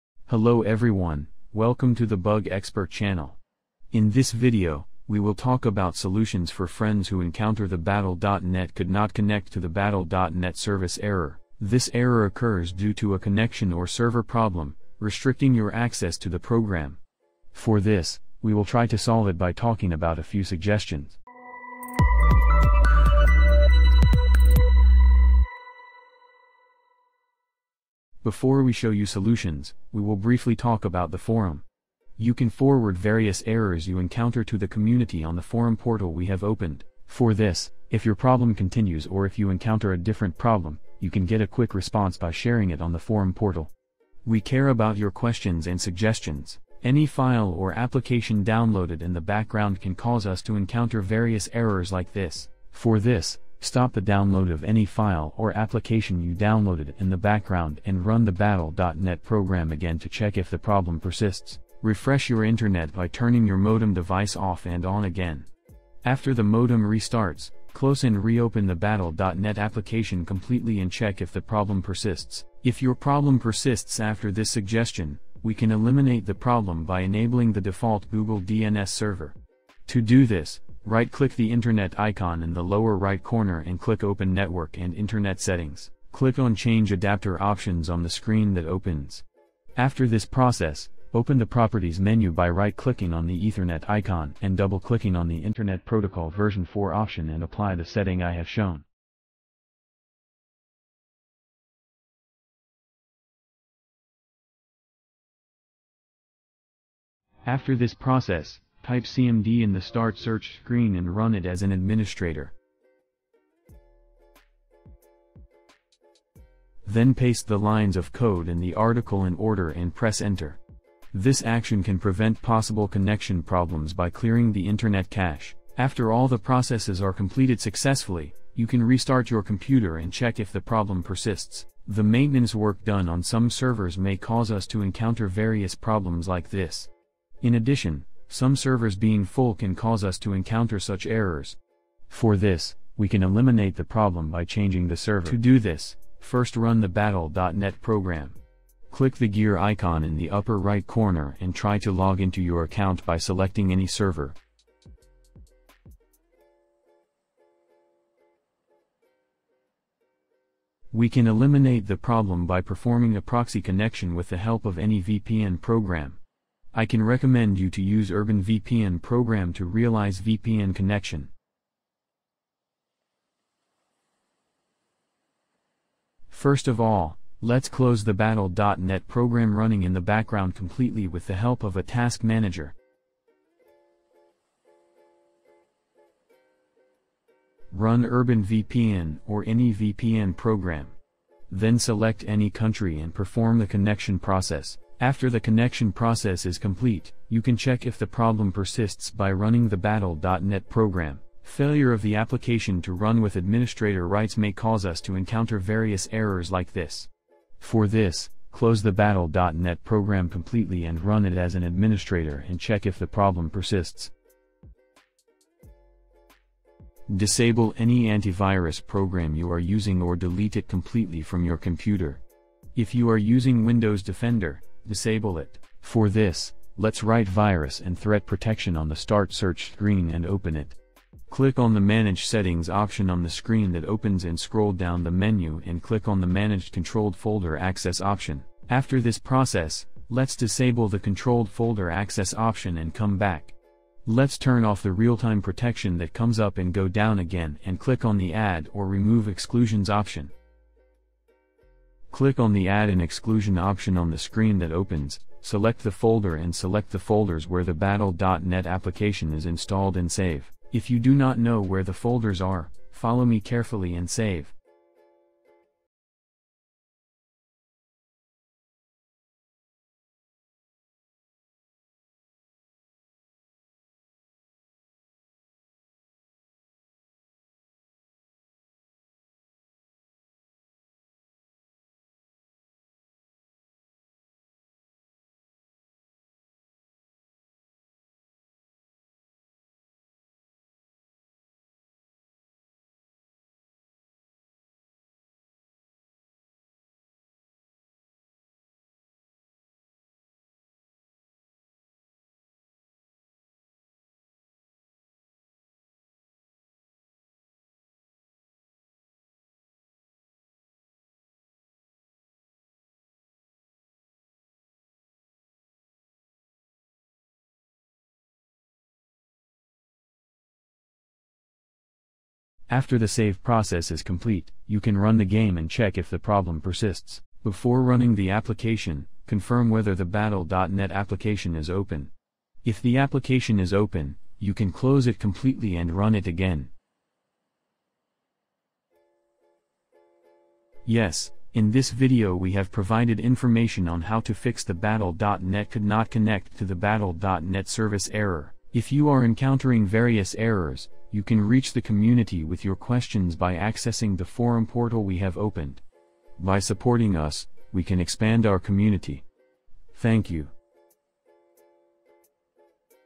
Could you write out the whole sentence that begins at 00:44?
We care about your questions and suggestions.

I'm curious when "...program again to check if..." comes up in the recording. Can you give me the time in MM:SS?
00:59.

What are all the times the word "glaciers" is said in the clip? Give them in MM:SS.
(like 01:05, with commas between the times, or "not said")
not said.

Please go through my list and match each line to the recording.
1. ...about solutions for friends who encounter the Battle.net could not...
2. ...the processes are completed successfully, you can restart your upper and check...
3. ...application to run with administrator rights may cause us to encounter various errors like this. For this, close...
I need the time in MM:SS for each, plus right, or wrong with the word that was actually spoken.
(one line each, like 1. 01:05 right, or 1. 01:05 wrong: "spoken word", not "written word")
1. 00:05 right
2. 02:06 wrong: "computer", not "upper"
3. 03:22 right.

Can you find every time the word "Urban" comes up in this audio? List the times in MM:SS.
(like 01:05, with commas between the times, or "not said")
02:48, 03:08.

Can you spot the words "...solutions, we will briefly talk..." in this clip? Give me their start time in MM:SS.
00:29.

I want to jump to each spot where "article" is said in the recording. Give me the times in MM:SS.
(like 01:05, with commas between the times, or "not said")
01:58.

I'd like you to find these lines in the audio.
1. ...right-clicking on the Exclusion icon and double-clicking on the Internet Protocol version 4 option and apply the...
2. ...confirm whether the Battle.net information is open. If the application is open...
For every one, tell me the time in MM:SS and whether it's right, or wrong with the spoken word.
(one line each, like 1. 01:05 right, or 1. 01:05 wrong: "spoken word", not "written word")
1. 01:32 wrong: "Ethernet", not "Exclusion"
2. 05:29 wrong: "application", not "information".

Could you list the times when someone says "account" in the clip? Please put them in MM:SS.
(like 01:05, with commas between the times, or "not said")
02:32.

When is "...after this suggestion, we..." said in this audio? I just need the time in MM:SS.
01:13.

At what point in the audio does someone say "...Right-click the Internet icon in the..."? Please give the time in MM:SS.
01:20.